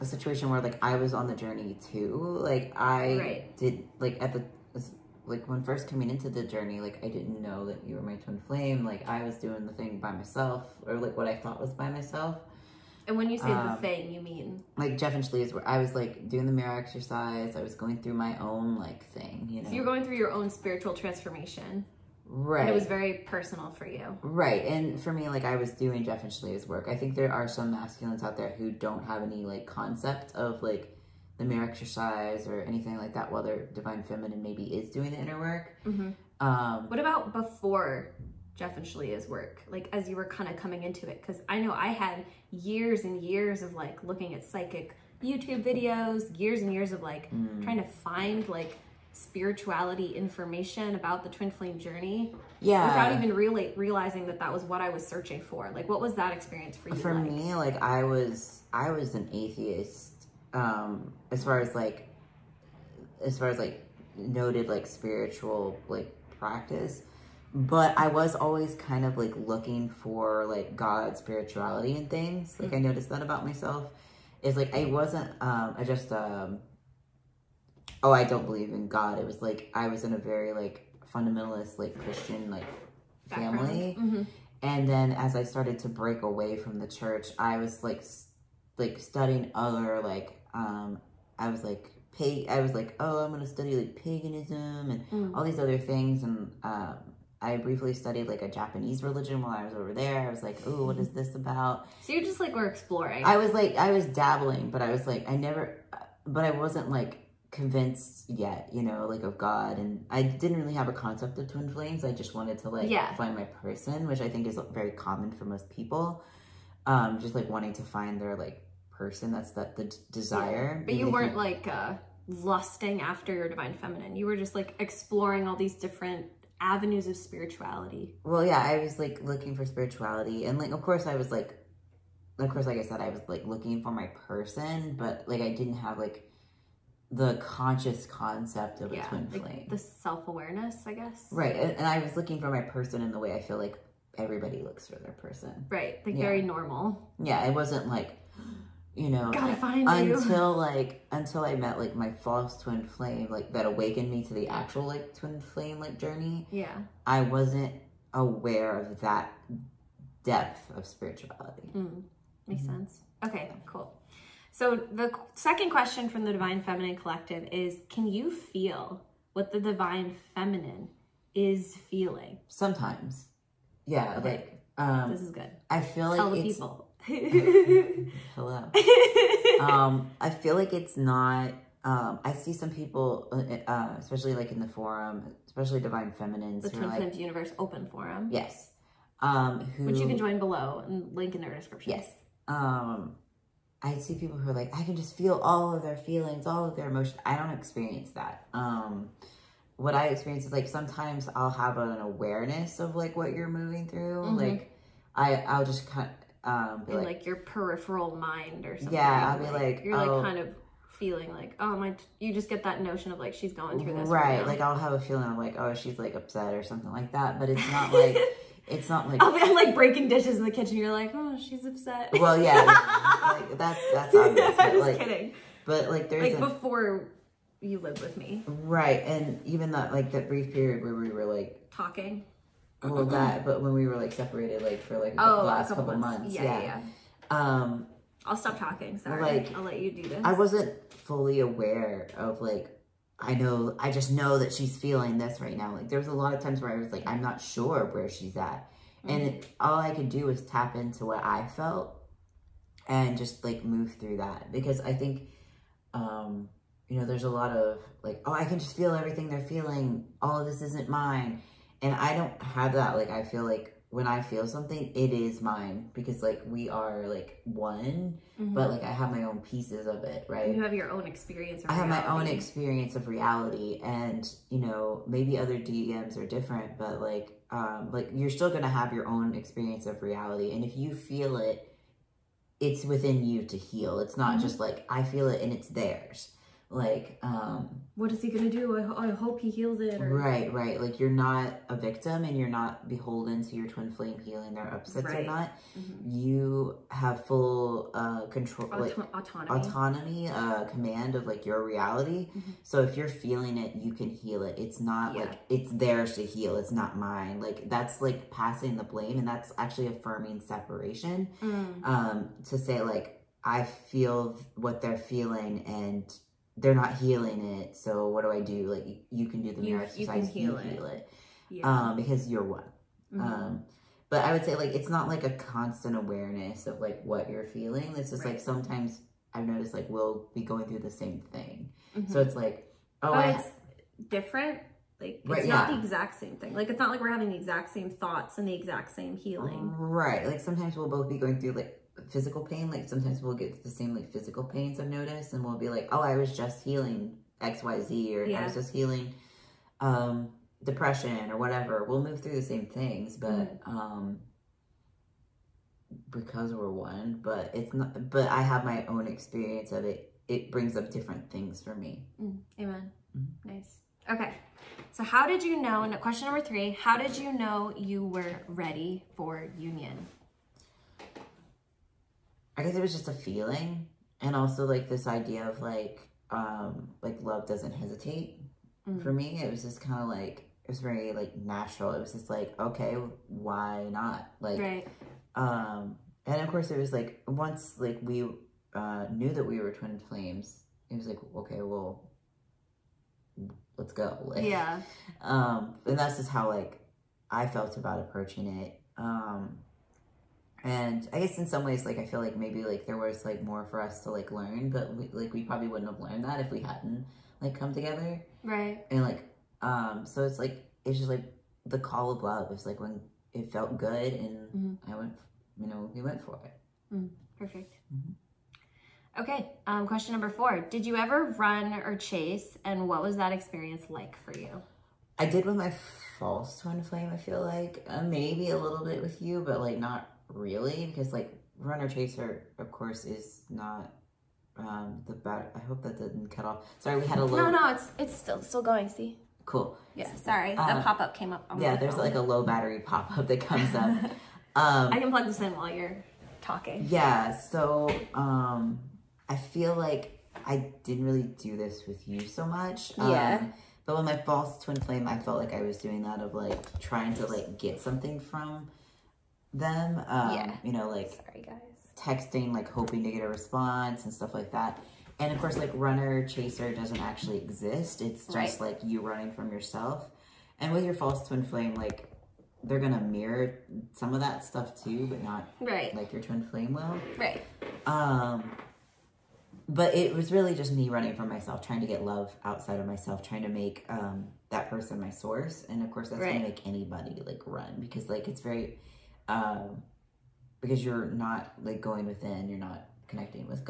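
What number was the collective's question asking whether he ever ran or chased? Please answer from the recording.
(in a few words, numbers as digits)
4.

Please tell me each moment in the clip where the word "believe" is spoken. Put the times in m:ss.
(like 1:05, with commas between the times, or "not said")
1:18.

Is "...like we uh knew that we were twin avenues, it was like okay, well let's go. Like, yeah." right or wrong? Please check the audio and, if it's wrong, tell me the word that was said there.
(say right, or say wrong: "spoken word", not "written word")
wrong: "flames", not "avenues".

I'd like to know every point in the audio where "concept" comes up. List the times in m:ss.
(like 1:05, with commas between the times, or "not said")
0:29, 1:50, 2:18.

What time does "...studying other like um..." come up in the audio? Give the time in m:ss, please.
1:28.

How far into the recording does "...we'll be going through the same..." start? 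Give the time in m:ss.
5:29.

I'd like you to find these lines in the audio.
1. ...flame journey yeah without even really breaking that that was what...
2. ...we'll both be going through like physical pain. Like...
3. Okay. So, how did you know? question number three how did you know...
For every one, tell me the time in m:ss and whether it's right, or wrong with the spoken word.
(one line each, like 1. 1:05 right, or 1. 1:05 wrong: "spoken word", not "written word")
1. 0:51 wrong: "realizing", not "breaking"
2. 5:40 right
3. 6:04 right.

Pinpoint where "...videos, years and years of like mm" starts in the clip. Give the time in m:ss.
0:45.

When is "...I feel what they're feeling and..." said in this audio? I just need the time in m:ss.
5:13.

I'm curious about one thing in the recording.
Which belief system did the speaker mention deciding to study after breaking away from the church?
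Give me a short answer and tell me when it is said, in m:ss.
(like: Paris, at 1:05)
Paganism, at 1:33.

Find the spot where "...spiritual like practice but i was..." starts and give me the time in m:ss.
1:04.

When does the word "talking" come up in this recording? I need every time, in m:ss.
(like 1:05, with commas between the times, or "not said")
3:51, 3:58, 7:26.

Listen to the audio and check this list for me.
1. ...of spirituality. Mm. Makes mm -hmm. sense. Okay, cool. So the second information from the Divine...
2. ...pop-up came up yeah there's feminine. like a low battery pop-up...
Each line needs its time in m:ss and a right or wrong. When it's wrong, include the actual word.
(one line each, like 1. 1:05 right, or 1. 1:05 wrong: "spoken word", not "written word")
1. 2:40 wrong: "question", not "information"
2. 7:20 wrong: "phone", not "feminine".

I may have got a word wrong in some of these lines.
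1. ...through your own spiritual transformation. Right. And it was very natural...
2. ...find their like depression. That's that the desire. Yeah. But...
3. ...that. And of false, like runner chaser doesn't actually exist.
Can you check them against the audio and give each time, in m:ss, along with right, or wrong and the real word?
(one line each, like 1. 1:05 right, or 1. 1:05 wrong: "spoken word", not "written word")
1. 0:20 wrong: "personal", not "natural"
2. 1:57 wrong: "person", not "depression"
3. 7:44 wrong: "course", not "false".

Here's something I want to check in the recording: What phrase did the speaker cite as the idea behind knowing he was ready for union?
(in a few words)
Love doesn't hesitate.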